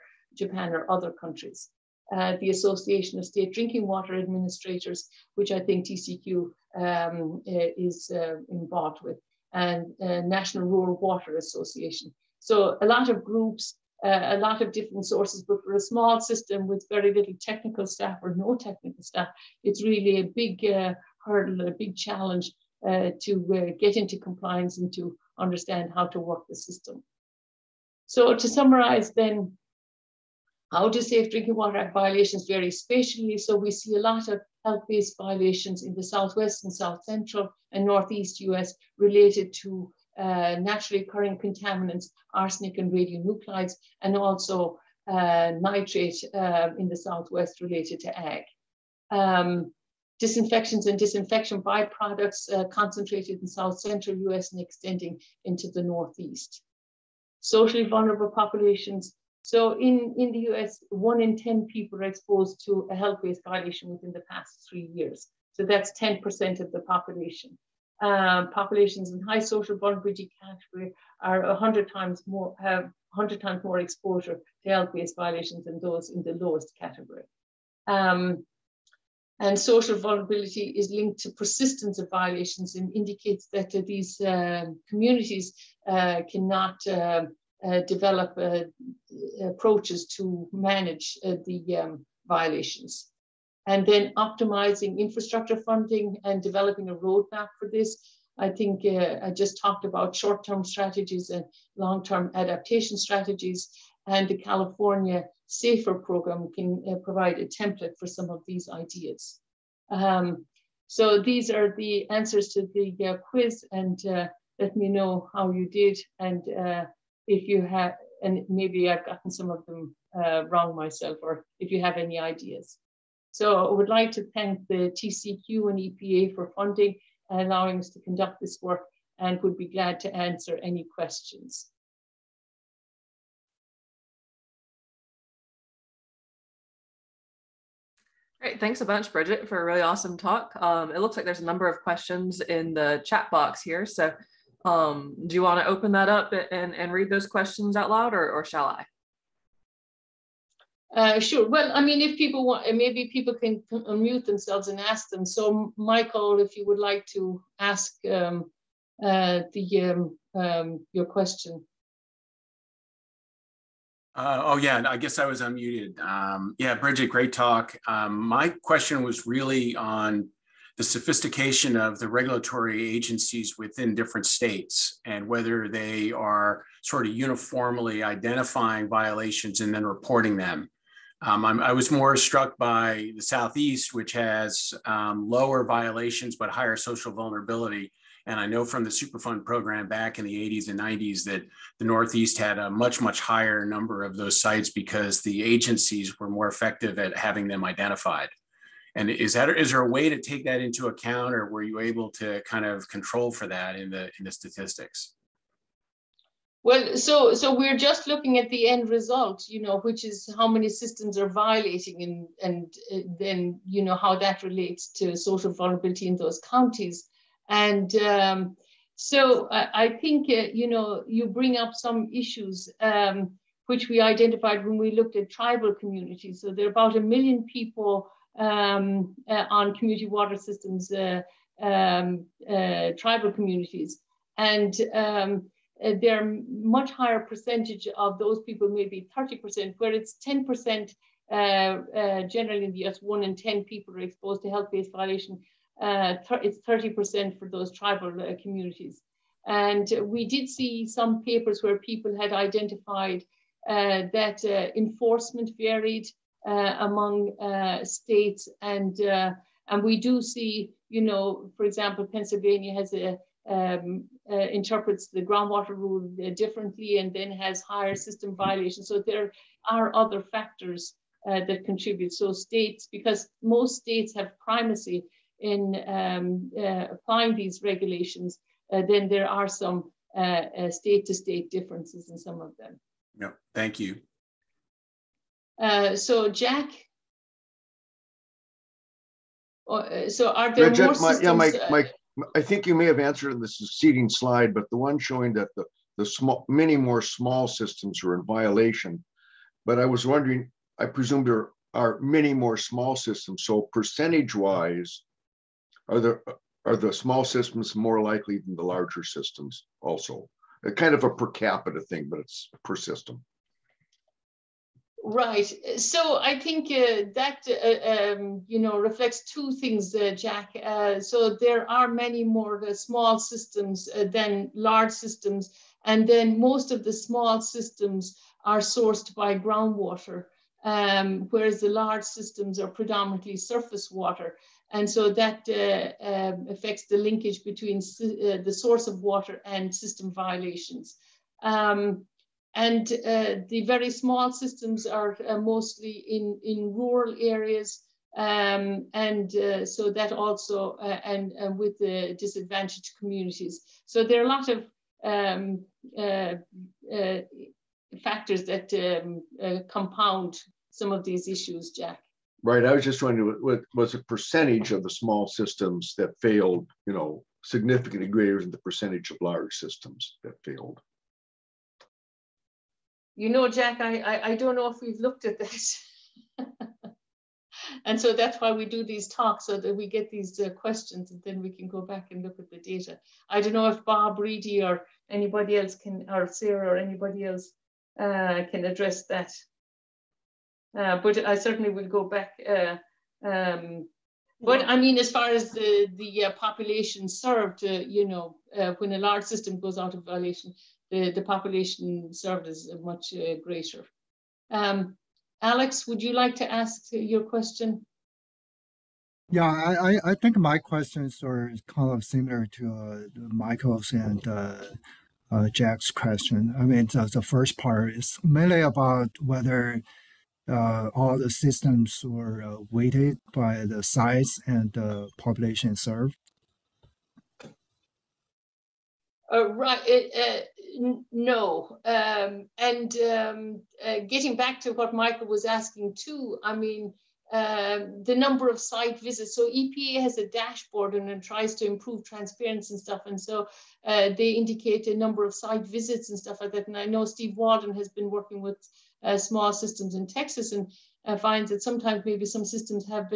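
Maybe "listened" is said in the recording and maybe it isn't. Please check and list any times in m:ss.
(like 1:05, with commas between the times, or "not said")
not said.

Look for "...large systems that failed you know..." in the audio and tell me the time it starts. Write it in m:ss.
6:09.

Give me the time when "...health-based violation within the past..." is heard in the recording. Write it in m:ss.
1:02.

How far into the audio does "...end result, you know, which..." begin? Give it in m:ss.
3:28.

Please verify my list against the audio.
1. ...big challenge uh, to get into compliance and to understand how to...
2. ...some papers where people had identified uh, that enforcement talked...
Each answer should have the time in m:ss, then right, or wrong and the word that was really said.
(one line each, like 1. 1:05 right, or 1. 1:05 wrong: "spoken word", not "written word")
1. 0:21 right
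2. 4:10 wrong: "varied", not "talked".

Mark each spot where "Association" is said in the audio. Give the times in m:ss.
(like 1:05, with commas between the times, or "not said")
0:02, 0:11.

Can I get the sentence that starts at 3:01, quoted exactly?
Um, i was more struck by the Southeast, which has um, lower violations but higher social vulnerability.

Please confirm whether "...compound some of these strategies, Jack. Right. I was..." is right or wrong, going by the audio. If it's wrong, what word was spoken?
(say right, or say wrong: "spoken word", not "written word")
wrong: "issues", not "strategies".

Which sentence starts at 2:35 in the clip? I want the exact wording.
So, Michael, if you would like to ask um, uh, the um, um, your question.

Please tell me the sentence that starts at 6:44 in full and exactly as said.
Um, Alex, would you like to ask your question?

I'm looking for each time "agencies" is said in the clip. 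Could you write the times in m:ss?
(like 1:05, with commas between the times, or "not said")
2:52, 3:15.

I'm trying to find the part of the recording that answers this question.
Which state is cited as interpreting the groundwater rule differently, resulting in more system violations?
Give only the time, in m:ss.
4:22.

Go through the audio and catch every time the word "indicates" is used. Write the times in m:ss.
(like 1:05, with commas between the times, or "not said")
1:22, 7:24.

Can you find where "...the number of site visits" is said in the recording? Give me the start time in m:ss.
7:18.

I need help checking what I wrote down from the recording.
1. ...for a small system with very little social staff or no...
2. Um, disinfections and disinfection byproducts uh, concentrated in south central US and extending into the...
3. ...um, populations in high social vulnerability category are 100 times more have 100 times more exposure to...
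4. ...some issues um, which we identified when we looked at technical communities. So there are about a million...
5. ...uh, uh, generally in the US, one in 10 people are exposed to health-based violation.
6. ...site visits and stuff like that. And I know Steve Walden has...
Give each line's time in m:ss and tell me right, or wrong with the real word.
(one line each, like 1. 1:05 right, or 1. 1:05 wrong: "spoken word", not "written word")
1. 0:15 wrong: "technical", not "social"
2. 0:49 right
3. 1:08 right
4. 3:41 wrong: "tribal", not "technical"
5. 4:01 right
6. 7:25 right.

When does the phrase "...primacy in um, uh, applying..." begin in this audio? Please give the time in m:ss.
4:34.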